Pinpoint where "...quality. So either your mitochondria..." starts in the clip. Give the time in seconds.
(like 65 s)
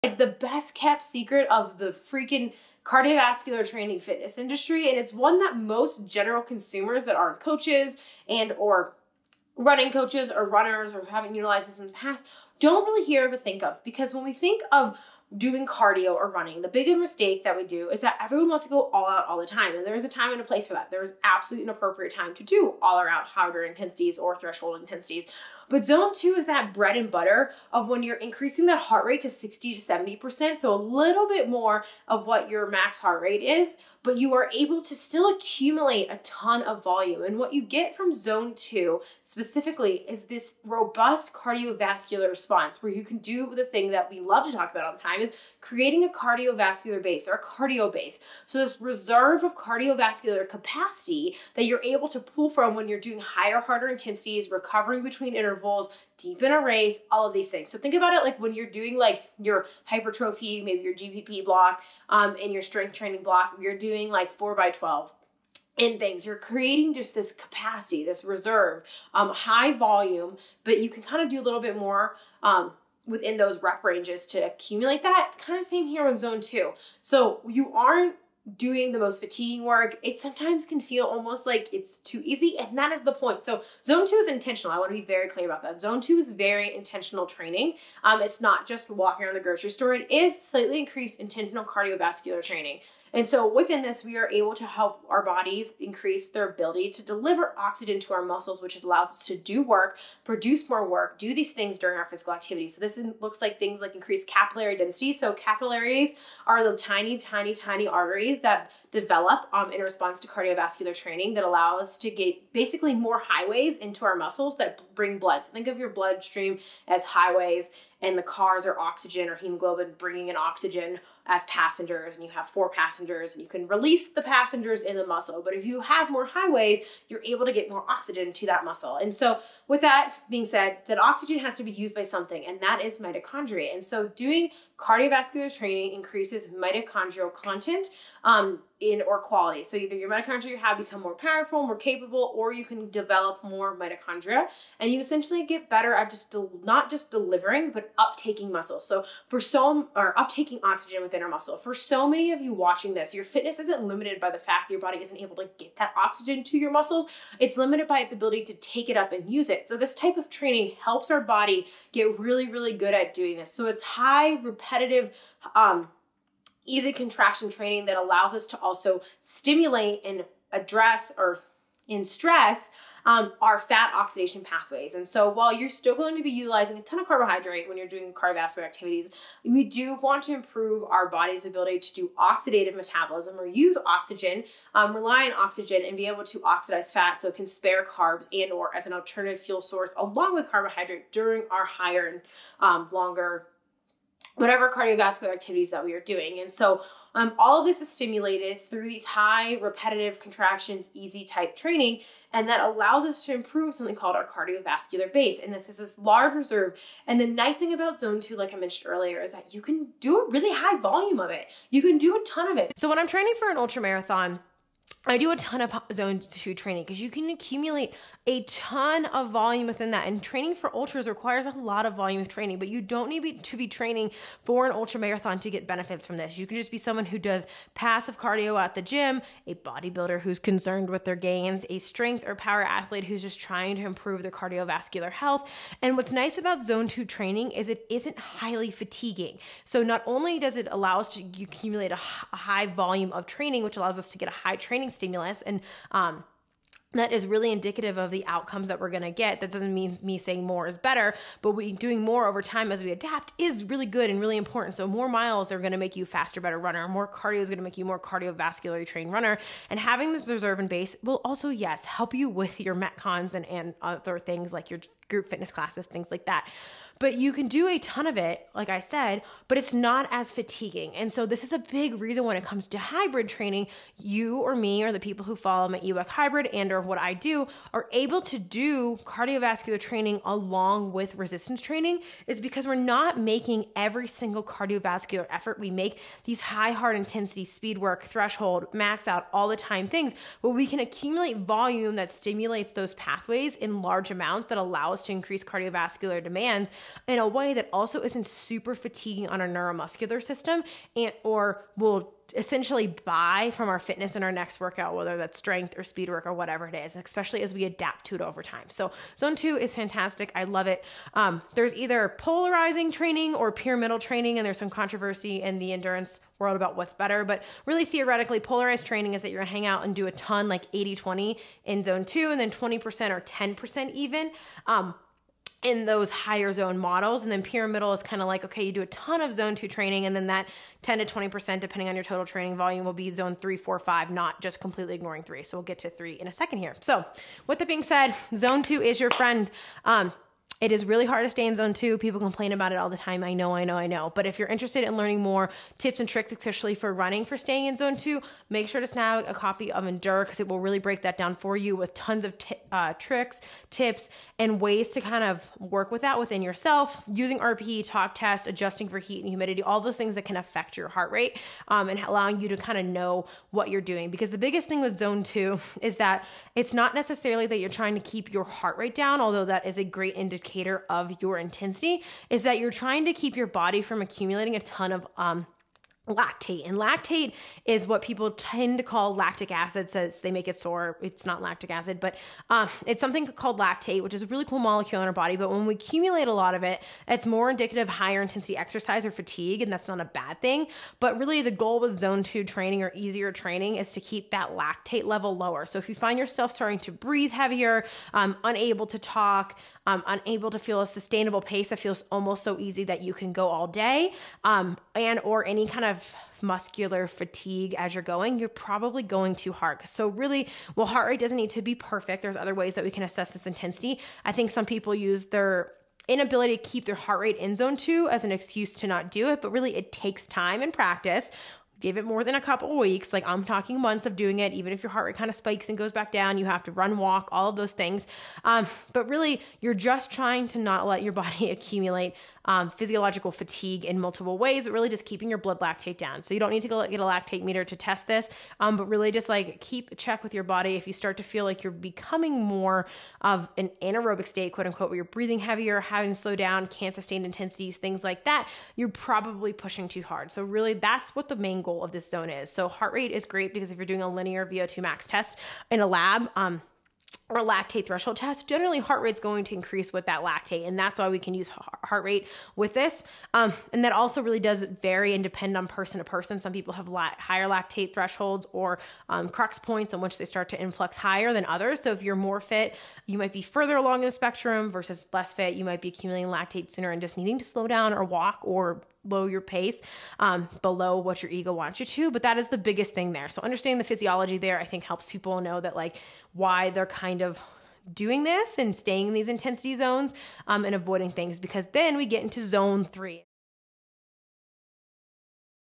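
139 s.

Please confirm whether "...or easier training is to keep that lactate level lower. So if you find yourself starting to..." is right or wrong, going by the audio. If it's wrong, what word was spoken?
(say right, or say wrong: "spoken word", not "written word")
right.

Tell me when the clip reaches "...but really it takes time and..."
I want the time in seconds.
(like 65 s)
419 s.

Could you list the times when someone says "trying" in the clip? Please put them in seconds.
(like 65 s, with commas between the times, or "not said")
233 s, 367 s, 372 s, 430 s.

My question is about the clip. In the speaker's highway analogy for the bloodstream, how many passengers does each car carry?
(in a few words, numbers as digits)
4.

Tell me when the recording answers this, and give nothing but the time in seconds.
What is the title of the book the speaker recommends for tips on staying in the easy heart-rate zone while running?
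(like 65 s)
349 s.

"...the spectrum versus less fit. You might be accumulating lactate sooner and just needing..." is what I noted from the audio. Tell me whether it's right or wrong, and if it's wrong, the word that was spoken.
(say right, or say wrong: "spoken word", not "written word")
right.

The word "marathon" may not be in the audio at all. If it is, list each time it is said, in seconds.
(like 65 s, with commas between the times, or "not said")
213 s, 224 s.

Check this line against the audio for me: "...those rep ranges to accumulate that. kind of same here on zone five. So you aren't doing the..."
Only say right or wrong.
wrong.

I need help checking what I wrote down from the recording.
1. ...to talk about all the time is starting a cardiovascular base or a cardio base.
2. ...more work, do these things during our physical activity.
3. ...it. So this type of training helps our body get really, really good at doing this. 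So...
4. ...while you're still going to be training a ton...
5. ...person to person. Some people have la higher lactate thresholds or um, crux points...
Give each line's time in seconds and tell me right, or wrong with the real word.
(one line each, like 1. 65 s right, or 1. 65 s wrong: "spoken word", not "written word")
1. 44 s wrong: "creating", not "starting"
2. 100 s right
3. 159 s right
4. 175 s wrong: "utilizing", not "training"
5. 465 s right.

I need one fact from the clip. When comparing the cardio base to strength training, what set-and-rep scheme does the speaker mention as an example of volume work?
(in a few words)
4 by 12.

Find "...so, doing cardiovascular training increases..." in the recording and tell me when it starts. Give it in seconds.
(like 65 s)
133 s.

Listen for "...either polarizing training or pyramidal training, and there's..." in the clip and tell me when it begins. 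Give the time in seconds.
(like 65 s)
311 s.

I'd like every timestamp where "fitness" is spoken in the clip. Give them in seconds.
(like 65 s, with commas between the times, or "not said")
3 s, 153 s, 265 s, 303 s.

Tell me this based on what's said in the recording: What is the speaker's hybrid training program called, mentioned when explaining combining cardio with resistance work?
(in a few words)
EWEC hybrid.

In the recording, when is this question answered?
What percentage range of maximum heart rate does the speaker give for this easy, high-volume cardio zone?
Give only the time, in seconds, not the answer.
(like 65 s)
29 s.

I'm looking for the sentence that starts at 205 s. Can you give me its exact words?
And this is this large reserve.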